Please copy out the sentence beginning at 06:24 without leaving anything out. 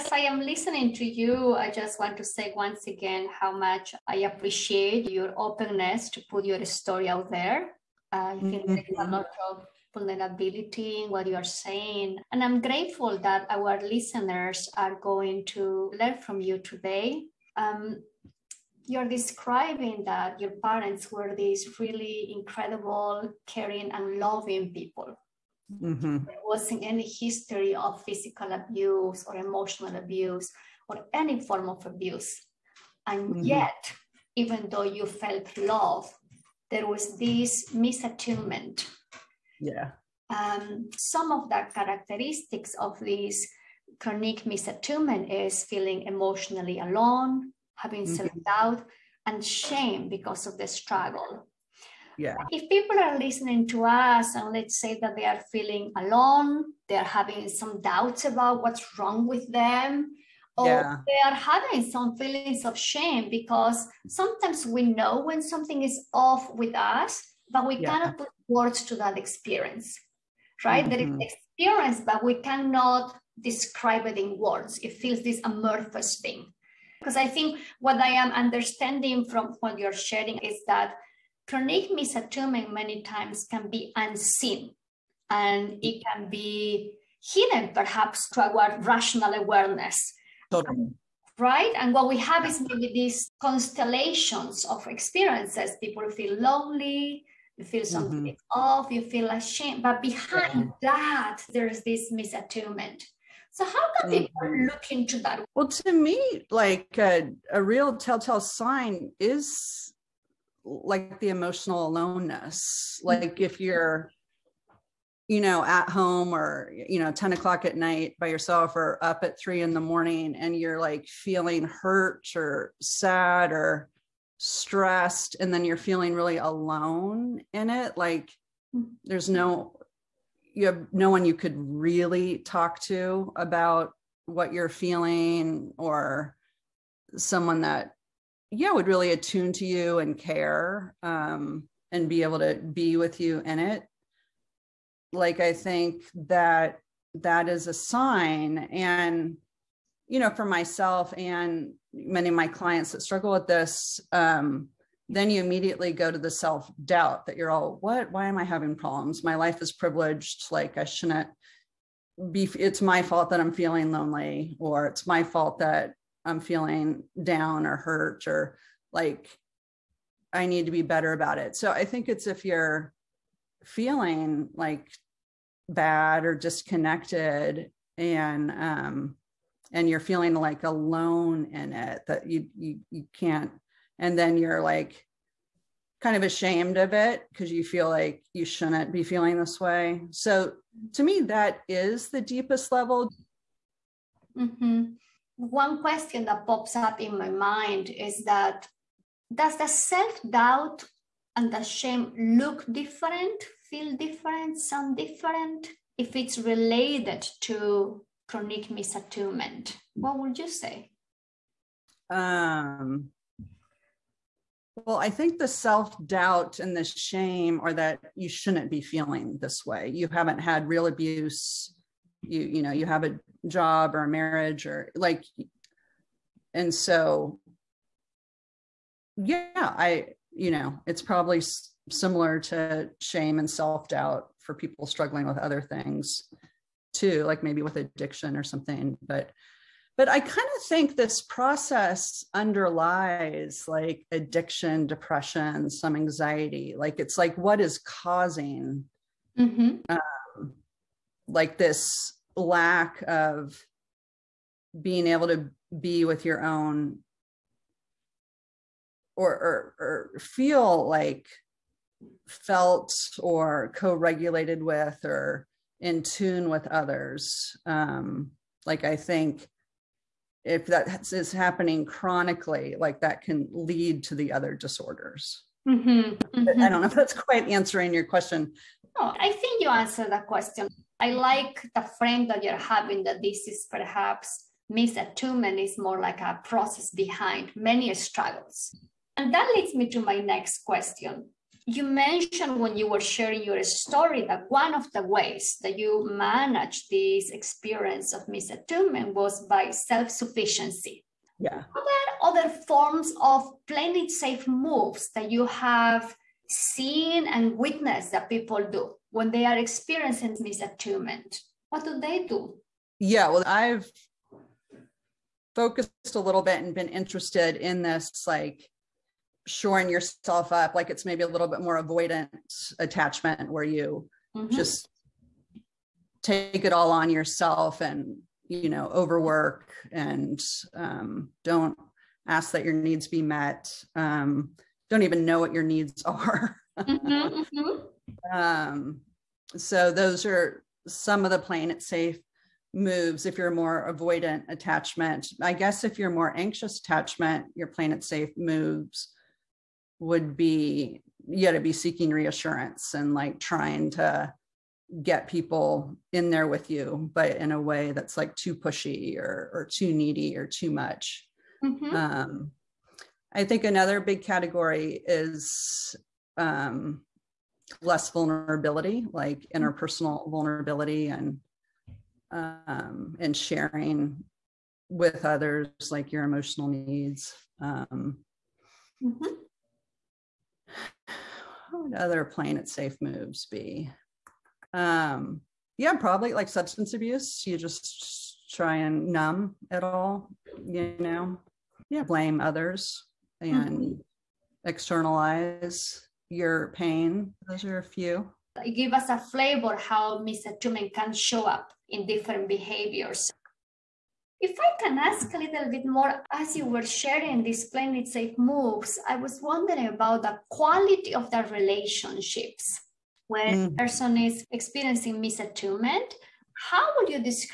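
Um, yeah, probably like substance abuse.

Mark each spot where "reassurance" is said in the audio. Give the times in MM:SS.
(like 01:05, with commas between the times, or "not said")
05:52.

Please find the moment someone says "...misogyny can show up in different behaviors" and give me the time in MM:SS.
06:40.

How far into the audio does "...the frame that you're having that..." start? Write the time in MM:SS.
04:41.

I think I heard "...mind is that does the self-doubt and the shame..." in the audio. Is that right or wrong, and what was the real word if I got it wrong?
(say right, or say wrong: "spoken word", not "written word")
right.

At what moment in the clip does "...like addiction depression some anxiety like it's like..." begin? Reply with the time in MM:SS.
04:03.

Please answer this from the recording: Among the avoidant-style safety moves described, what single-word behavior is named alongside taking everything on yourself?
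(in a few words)
overwork.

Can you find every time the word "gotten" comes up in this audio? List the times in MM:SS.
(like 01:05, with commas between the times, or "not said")
not said.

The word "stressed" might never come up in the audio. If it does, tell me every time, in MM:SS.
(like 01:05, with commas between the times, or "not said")
02:04.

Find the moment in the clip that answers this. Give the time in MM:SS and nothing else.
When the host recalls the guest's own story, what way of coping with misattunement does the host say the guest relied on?
04:59.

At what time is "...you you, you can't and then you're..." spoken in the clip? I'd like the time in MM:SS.
03:02.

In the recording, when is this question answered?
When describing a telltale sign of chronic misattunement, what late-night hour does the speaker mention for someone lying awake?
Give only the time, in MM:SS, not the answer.
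01:59.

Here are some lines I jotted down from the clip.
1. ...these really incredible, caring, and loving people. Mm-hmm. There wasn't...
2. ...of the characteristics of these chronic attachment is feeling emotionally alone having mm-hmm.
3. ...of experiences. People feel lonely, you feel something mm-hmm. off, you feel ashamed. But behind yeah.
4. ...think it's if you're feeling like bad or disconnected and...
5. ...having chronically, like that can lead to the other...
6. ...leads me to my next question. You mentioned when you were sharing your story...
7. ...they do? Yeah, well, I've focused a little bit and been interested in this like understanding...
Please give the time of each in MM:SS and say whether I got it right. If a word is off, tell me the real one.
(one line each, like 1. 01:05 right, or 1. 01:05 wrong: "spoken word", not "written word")
1. 00:21 right
2. 00:41 wrong: "misattunement", not "attachment"
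3. 01:34 right
4. 02:51 right
5. 04:31 wrong: "happening", not "having"
6. 04:49 right
7. 05:11 wrong: "shoring", not "understanding".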